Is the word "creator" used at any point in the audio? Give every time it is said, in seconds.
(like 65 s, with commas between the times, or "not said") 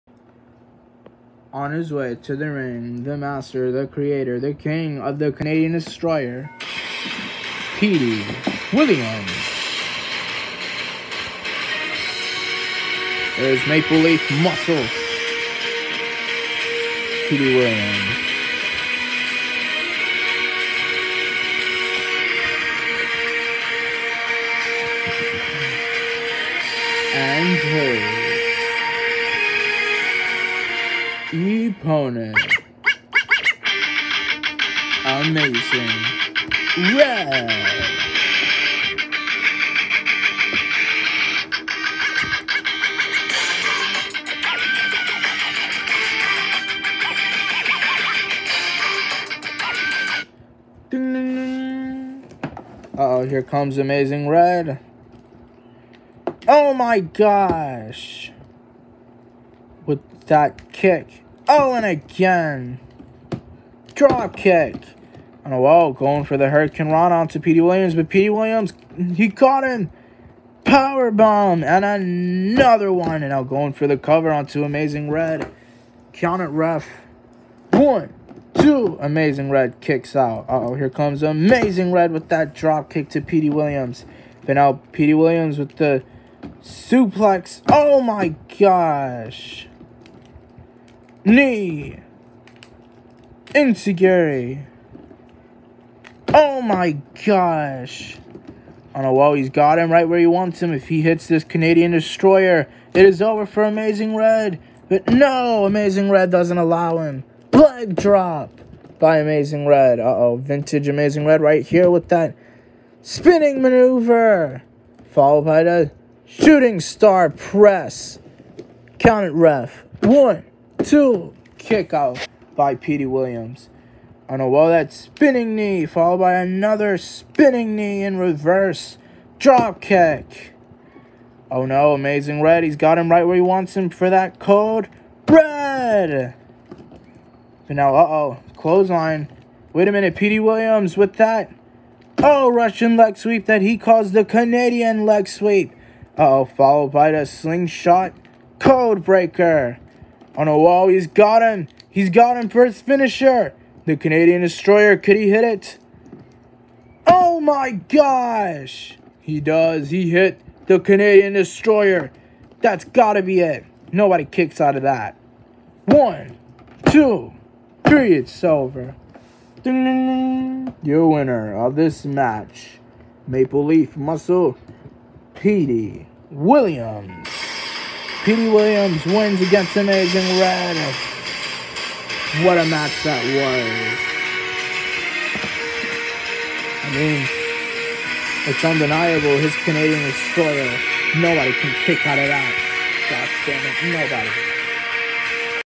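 3 s.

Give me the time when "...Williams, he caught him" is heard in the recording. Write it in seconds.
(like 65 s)
68 s.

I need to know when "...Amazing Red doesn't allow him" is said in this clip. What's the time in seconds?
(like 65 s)
105 s.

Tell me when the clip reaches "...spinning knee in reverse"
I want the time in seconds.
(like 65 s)
126 s.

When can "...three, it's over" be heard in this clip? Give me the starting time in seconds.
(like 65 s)
167 s.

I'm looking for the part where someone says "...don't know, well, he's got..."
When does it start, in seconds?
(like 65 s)
98 s.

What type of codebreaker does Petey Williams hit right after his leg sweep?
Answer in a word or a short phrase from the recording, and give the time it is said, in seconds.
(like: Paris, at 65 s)
Slingshot code breaker, at 147 s.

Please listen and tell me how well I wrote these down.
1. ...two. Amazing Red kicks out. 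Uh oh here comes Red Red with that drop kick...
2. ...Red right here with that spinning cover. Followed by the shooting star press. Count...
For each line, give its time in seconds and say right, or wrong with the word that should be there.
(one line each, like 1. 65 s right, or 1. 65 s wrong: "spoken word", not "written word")
1. 78 s wrong: "Amazing", not "Red"
2. 111 s wrong: "maneuver", not "cover".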